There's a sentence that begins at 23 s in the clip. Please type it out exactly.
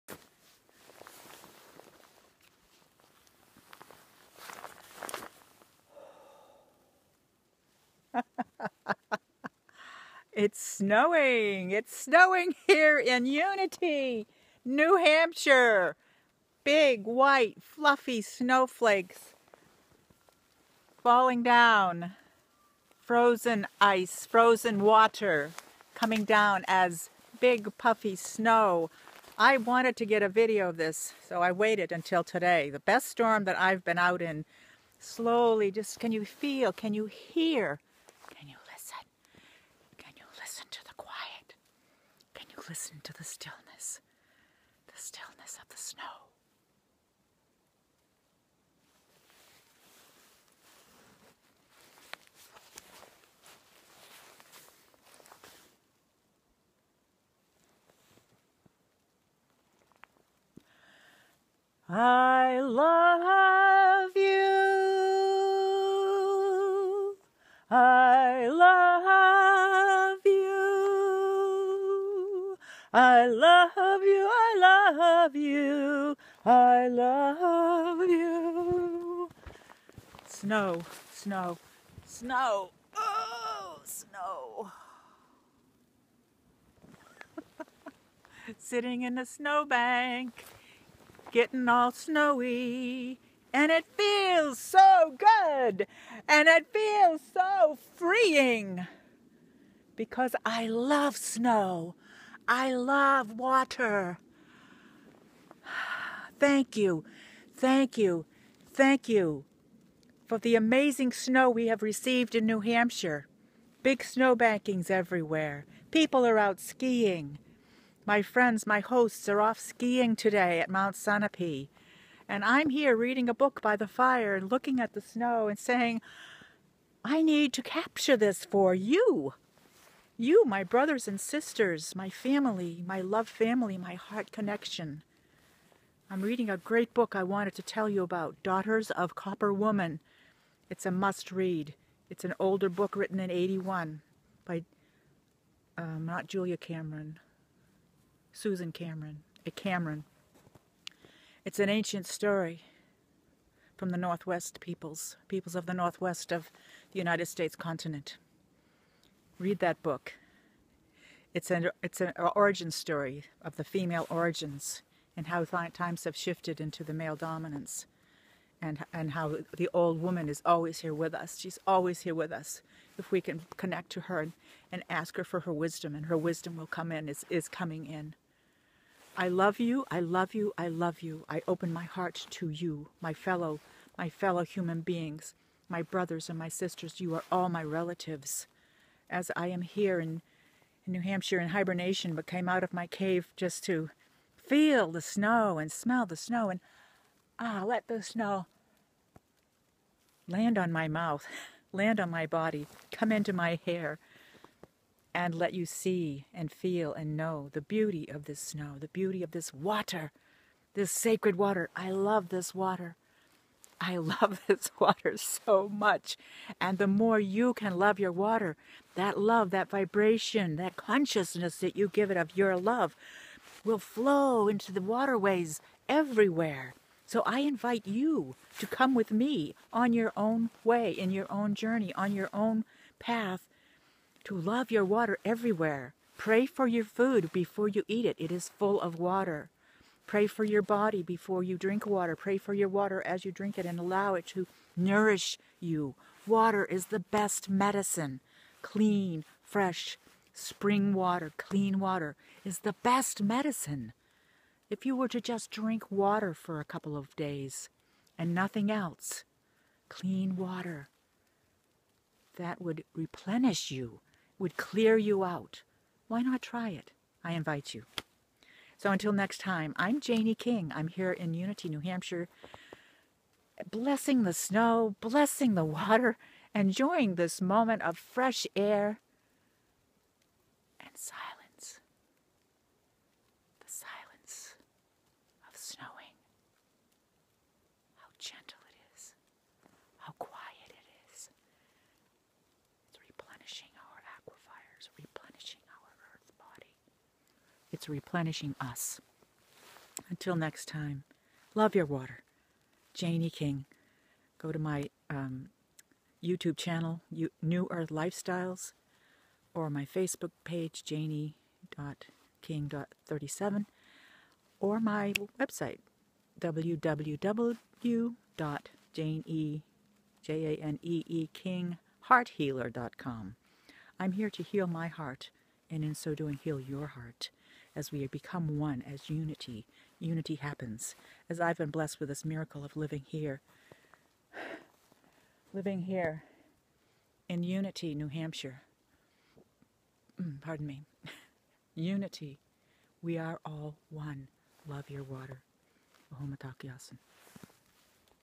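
Frozen ice, frozen water coming down as big, puffy snow.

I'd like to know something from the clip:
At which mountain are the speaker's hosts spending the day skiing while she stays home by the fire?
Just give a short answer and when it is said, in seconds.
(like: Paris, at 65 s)
Mount Sunapee, at 120 s.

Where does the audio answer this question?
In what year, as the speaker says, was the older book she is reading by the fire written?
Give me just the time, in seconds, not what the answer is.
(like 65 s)
143 s.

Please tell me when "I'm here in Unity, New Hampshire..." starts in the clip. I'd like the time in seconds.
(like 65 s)
270 s.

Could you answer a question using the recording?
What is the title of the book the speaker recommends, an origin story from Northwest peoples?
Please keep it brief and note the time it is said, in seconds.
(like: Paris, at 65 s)
Daughters of Copper Woman, at 138 s.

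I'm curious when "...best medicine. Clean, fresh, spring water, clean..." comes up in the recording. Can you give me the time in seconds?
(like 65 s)
246 s.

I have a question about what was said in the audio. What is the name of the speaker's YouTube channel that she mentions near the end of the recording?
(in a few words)
New Earth Lifestyles.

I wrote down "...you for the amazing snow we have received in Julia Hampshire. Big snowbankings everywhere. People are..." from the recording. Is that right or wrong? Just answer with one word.
wrong.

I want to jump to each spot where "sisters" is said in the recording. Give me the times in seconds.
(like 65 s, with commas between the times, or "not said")
131 s, 186 s.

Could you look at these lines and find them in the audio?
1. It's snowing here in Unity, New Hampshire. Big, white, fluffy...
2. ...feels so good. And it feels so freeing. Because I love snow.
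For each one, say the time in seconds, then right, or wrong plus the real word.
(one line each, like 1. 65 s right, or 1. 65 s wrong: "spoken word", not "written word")
1. 11 s right
2. 93 s right.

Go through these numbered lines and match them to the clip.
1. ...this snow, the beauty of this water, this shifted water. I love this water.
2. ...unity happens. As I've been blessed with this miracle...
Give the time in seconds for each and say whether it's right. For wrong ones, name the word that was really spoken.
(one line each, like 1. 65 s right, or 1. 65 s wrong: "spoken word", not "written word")
1. 208 s wrong: "sacred", not "shifted"
2. 329 s right.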